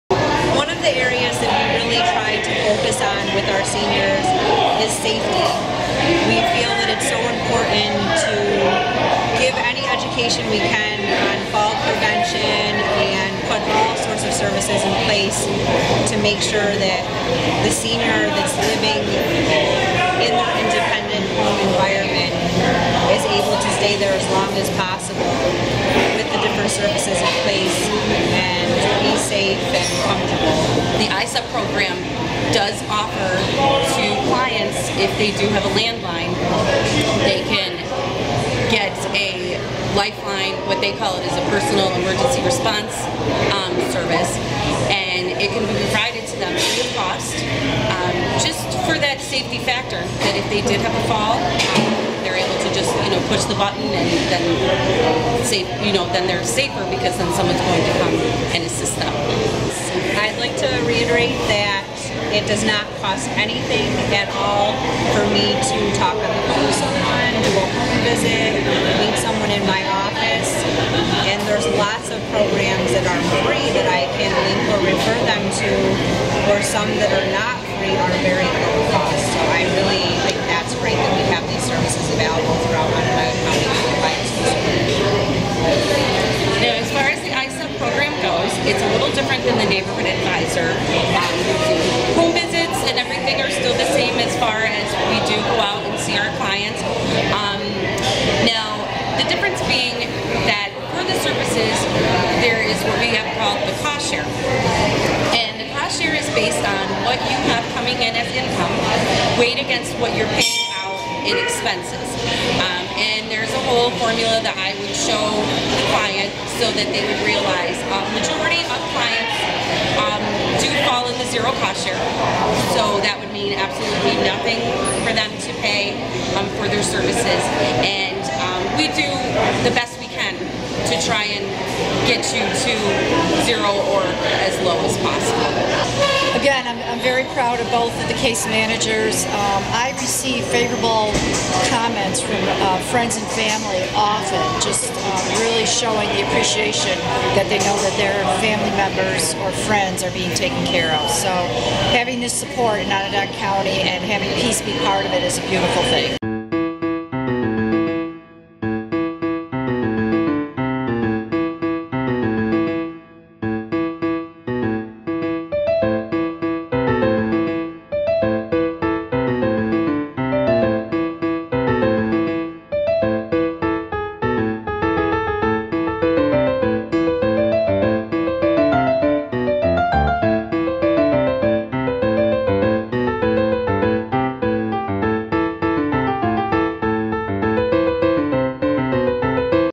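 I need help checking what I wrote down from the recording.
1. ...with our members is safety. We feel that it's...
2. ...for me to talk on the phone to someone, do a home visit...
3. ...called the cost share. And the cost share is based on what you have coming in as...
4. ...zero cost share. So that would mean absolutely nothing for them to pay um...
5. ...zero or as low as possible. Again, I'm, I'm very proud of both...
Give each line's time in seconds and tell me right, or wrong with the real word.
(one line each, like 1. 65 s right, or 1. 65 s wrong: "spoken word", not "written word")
1. 3 s wrong: "seniors", not "members"
2. 65 s right
3. 103 s right
4. 121 s right
5. 133 s right.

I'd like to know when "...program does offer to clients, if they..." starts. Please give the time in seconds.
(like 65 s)
31 s.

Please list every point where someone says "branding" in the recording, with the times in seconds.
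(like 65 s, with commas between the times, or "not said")
not said.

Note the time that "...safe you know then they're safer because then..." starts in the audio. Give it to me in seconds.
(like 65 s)
55 s.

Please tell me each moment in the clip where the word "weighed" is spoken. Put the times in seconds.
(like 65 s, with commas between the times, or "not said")
109 s.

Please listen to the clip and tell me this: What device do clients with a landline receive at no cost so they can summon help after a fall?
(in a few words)
Lifeline.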